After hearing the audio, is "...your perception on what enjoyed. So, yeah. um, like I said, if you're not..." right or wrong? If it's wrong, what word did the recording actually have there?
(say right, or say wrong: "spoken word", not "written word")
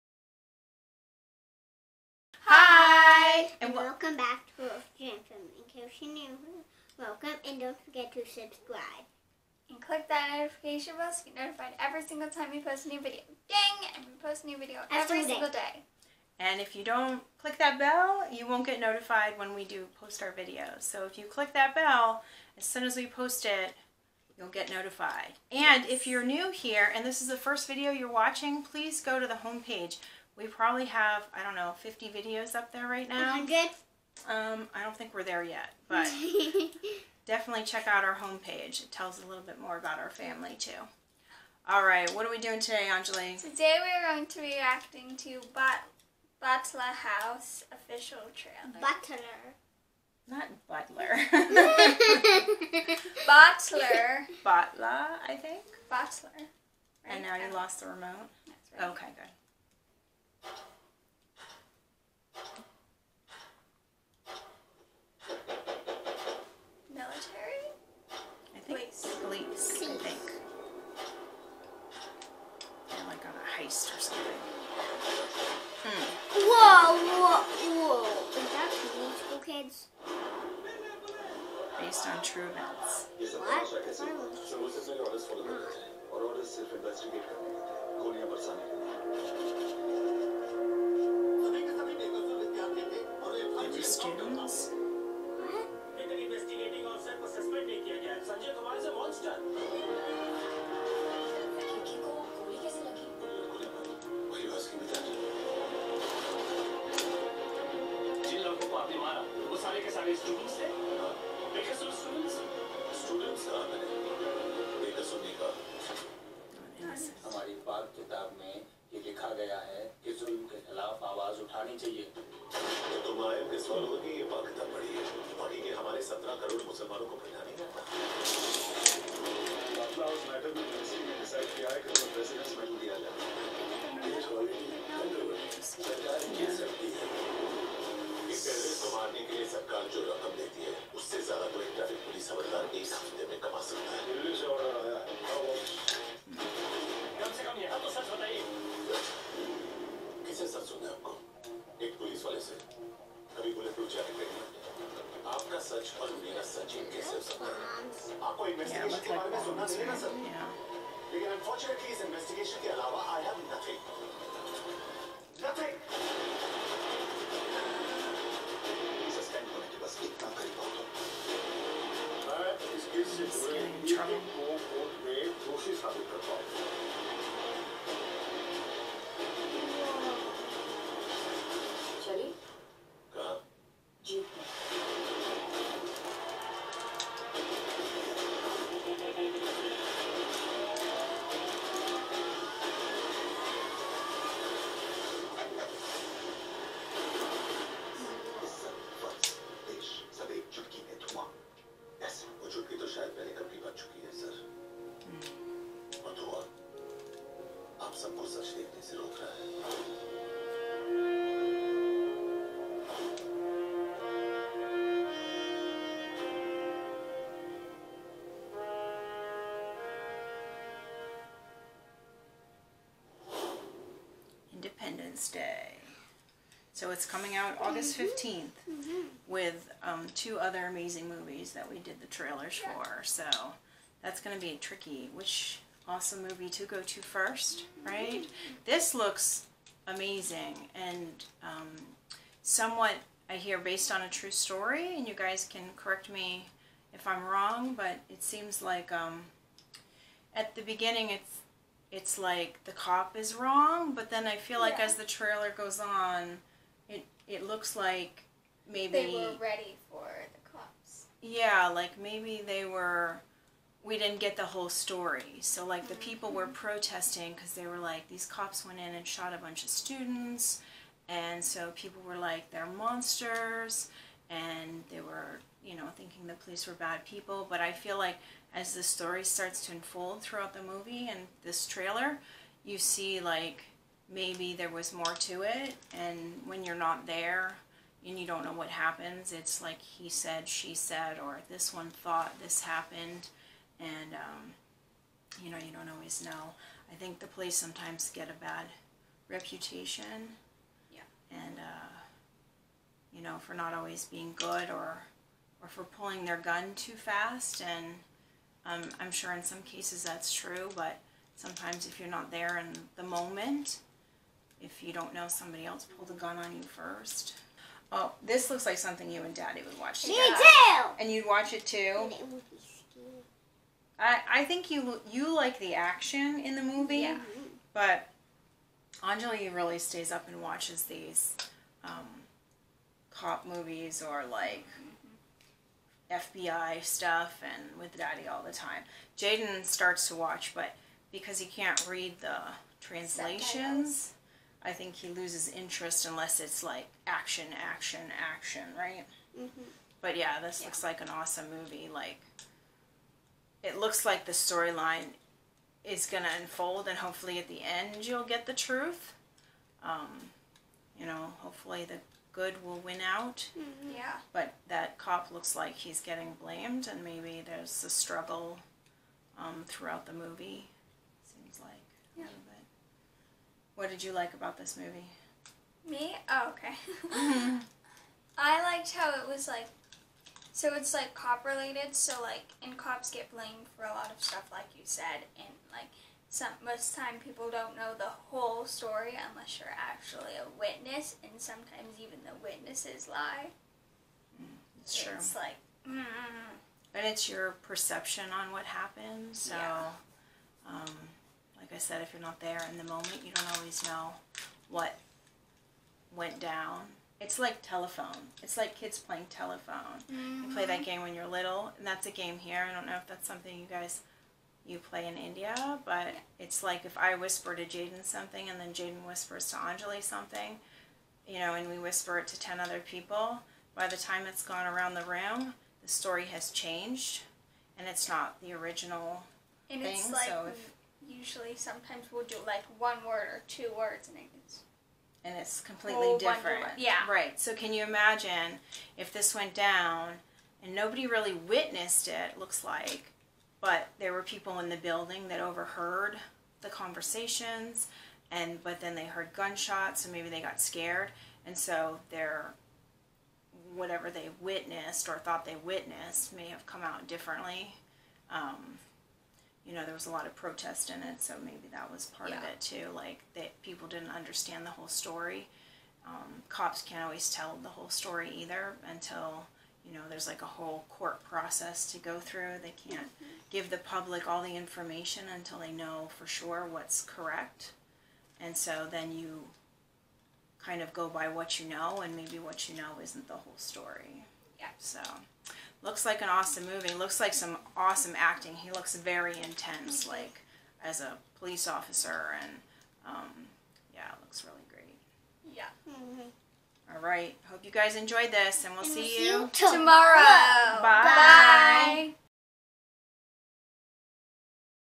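wrong: "happened", not "enjoyed".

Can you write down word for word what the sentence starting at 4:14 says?
as the trailer goes on, it it looks like maybe they were ready for the cops.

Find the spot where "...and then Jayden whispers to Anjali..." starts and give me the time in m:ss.
6:58.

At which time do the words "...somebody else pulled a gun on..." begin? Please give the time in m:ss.
5:15.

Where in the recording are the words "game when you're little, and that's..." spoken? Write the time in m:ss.
6:50.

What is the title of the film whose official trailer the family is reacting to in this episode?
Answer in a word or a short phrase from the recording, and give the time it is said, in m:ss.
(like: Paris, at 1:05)
Batla House, at 0:46.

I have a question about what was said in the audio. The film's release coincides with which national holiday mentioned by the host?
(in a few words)
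Independence Day.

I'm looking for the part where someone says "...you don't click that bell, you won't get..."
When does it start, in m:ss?
0:16.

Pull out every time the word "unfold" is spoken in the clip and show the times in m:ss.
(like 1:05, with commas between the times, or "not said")
4:39, 5:56.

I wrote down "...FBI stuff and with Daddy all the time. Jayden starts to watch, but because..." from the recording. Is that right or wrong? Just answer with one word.
right.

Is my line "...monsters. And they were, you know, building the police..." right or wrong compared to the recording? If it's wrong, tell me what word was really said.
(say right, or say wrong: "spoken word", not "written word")
wrong: "thinking", not "building".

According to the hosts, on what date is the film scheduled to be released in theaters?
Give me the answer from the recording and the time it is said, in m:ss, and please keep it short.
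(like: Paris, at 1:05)
August 15th, at 3:47.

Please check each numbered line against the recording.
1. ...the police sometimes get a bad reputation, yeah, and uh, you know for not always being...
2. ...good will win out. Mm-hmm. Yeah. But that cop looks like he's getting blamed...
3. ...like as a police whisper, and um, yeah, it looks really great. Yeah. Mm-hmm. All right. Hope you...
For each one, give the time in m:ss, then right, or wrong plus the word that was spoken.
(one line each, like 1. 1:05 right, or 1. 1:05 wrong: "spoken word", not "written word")
1. 4:57 right
2. 6:02 right
3. 8:10 wrong: "officer", not "whisper".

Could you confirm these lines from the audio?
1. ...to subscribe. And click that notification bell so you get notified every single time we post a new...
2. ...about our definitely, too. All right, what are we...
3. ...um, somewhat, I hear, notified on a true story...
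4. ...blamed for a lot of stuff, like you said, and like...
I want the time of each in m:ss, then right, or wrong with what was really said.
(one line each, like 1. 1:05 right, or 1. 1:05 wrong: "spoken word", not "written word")
1. 0:08 right
2. 0:39 wrong: "family", not "definitely"
3. 4:01 wrong: "based", not "notified"
4. 6:23 right.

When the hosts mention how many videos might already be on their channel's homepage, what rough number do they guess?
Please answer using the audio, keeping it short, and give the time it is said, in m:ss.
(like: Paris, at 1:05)
50, at 0:31.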